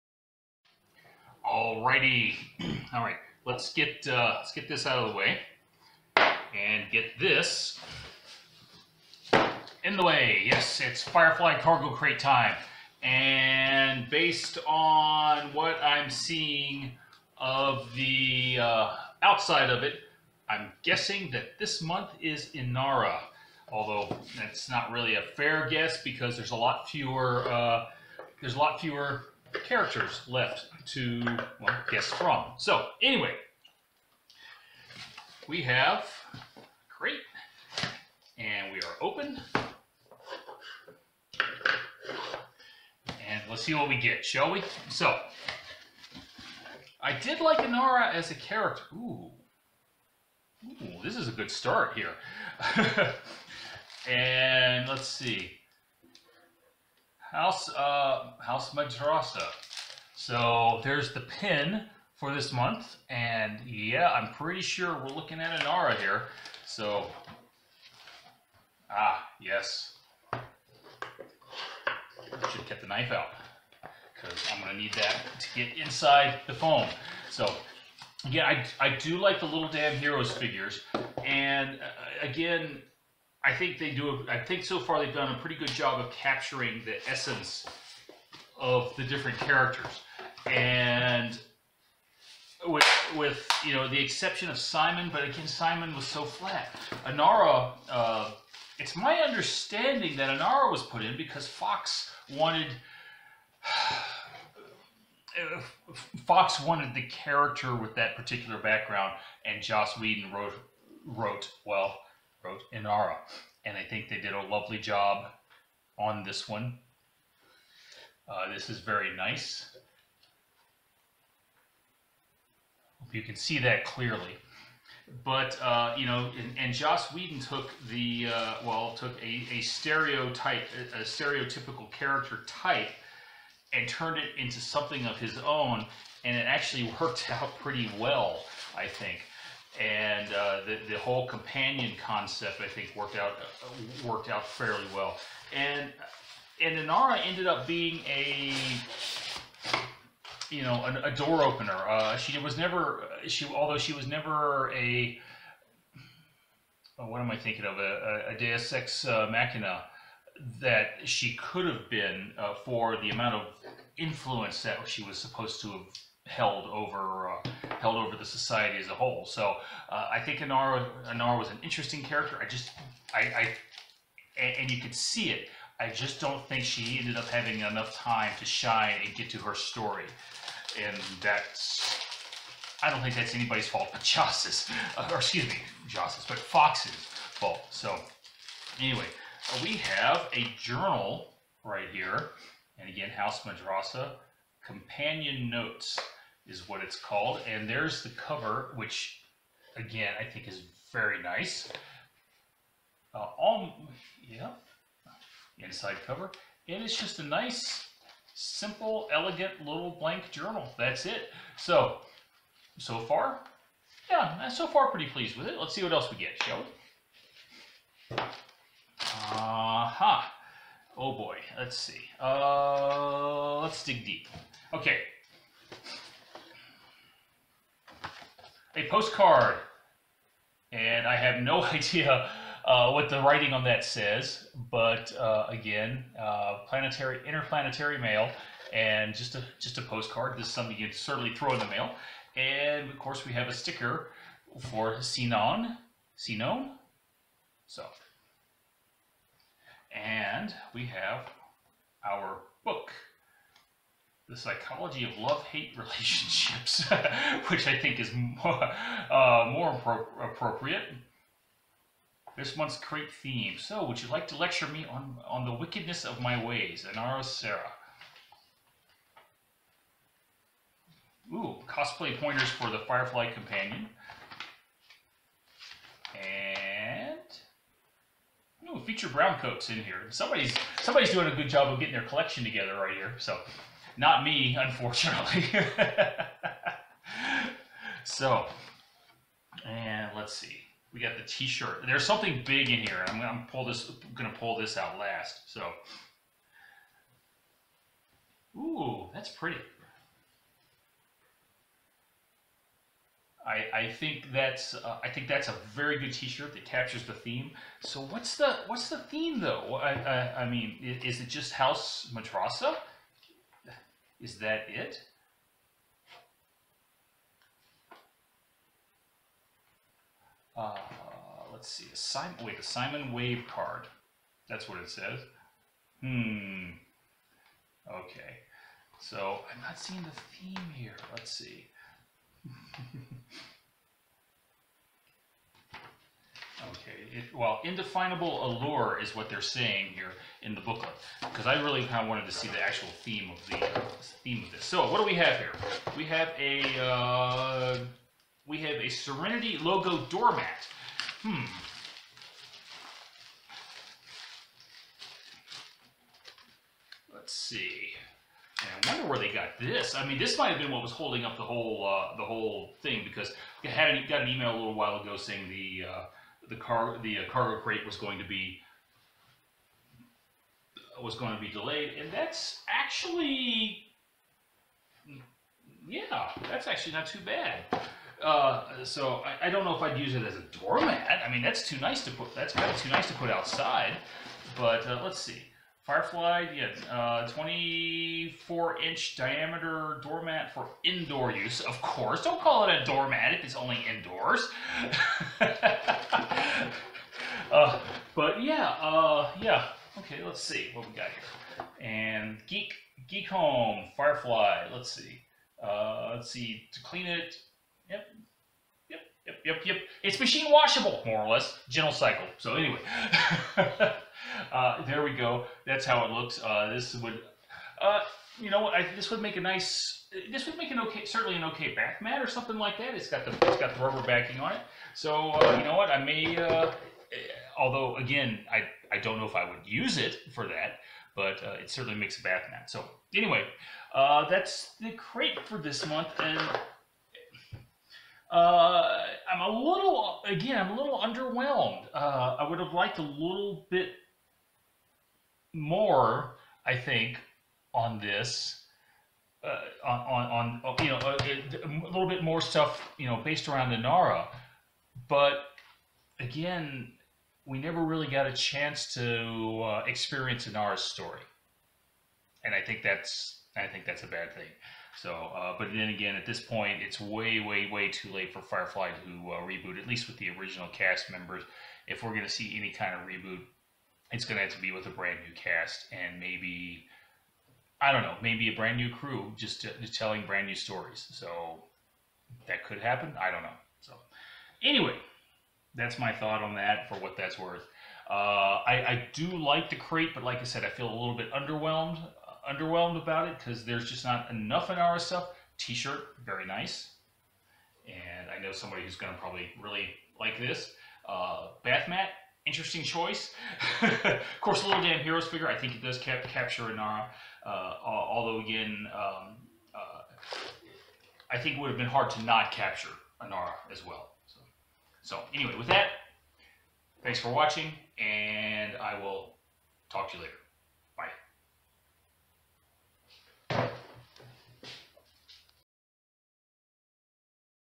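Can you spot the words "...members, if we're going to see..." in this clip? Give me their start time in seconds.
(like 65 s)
471 s.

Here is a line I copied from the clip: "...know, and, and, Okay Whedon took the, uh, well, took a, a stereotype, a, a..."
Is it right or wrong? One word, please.
wrong.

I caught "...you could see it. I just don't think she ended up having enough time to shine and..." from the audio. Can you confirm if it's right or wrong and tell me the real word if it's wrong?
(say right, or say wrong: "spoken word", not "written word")
right.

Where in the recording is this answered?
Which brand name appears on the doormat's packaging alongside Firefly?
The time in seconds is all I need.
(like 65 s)
403 s.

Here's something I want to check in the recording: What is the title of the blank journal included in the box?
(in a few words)
House Madrassa Companion Notes.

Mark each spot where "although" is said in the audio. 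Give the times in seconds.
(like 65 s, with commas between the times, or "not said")
23 s, 153 s, 427 s, 507 s.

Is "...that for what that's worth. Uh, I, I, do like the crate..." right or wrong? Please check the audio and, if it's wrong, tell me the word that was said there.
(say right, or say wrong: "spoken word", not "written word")
right.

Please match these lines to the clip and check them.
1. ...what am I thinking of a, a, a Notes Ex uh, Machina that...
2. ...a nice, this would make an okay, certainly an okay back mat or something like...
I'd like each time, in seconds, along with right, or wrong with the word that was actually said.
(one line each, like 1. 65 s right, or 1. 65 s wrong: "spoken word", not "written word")
1. 157 s wrong: "Deus", not "Notes"
2. 419 s right.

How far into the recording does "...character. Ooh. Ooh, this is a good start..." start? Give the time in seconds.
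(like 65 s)
48 s.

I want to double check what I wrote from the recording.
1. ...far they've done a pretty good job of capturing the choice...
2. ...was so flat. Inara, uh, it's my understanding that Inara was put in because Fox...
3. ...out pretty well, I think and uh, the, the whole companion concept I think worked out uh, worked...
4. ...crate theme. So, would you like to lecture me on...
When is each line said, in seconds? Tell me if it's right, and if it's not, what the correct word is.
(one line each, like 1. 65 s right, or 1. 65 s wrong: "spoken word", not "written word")
1. 84 s wrong: "essence", not "choice"
2. 95 s right
3. 137 s right
4. 262 s right.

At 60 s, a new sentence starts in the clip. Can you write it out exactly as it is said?
So there's the pin for this month.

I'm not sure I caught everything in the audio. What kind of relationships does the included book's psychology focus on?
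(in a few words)
love-hate.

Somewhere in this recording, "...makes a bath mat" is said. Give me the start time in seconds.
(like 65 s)
431 s.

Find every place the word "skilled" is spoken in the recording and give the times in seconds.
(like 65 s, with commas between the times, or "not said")
not said.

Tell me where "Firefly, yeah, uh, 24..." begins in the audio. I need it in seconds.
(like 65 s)
385 s.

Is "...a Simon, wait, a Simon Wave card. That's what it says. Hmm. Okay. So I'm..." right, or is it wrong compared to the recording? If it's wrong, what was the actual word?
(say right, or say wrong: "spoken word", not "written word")
right.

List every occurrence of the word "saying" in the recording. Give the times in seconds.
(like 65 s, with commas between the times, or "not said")
339 s, 365 s.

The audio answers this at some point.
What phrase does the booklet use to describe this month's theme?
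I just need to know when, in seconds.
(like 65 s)
337 s.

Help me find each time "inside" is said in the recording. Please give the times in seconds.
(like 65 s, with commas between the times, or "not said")
75 s, 205 s.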